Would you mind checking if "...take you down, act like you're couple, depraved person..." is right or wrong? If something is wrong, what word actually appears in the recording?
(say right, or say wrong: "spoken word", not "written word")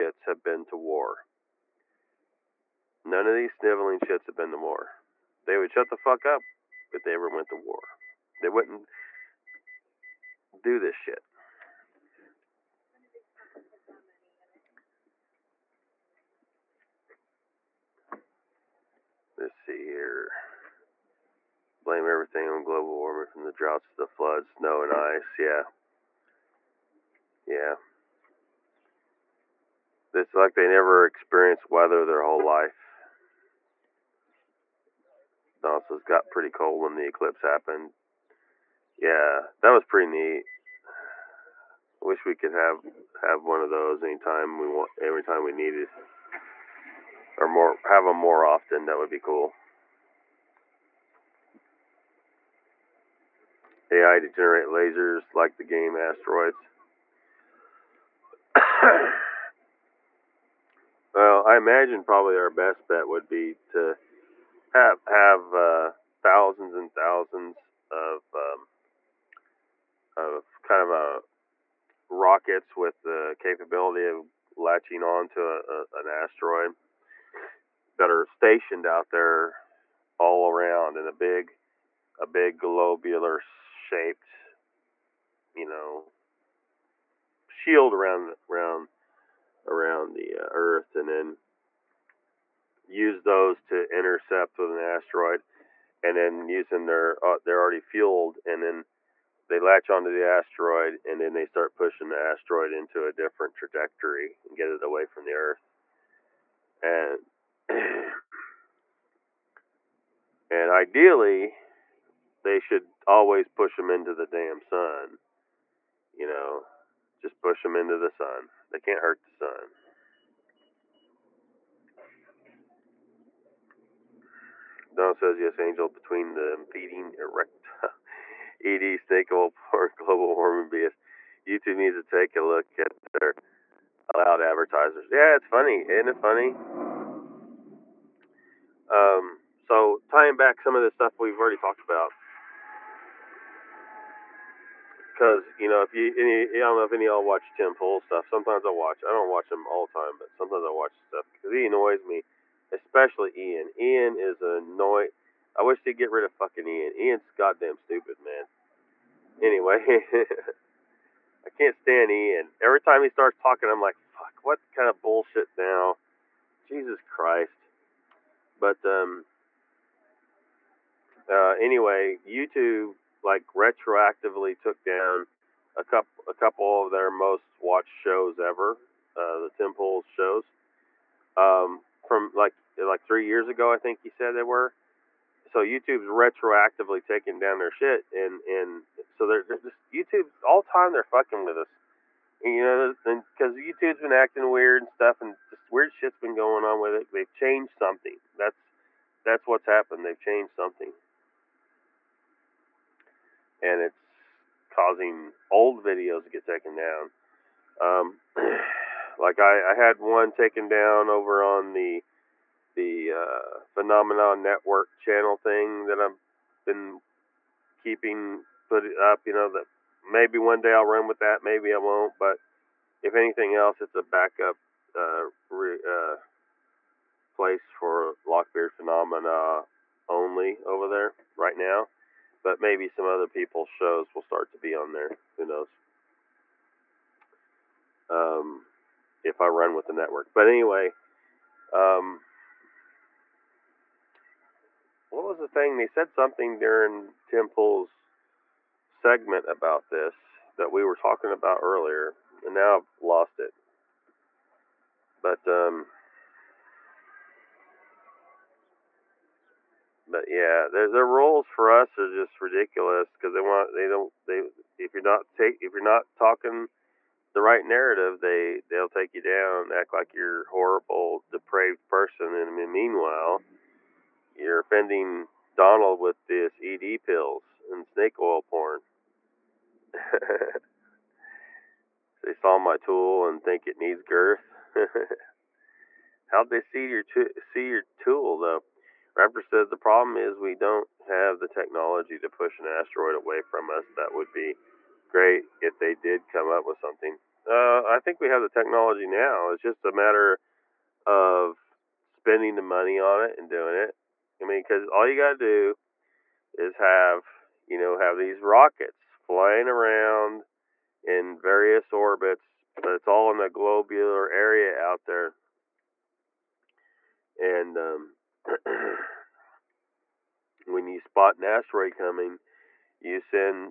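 wrong: "horrible", not "couple".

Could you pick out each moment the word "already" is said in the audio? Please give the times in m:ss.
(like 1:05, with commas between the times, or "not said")
1:37, 2:21.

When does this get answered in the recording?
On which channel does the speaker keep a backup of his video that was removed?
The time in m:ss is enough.
3:33.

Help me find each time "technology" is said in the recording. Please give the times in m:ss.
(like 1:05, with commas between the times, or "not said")
4:51, 4:58.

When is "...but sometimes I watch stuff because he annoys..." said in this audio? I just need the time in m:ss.
2:30.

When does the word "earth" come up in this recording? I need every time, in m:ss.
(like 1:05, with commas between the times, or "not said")
1:30, 1:45.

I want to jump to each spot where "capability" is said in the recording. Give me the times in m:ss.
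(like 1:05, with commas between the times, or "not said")
1:13.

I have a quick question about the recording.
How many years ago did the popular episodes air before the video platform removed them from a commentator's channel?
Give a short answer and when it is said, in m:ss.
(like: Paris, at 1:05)
3 years, at 3:03.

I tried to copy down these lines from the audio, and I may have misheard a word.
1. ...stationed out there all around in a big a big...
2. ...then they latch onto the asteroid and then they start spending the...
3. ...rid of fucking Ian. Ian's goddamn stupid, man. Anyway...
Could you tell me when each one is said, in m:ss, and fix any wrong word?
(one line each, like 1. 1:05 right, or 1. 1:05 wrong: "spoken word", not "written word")
1. 1:18 right
2. 1:38 wrong: "pushing", not "spending"
3. 2:36 right.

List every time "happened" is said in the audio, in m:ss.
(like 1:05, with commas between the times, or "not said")
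0:37, 3:19.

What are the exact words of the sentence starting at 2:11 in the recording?
YouTube needs to take a look at their allowed advertisers.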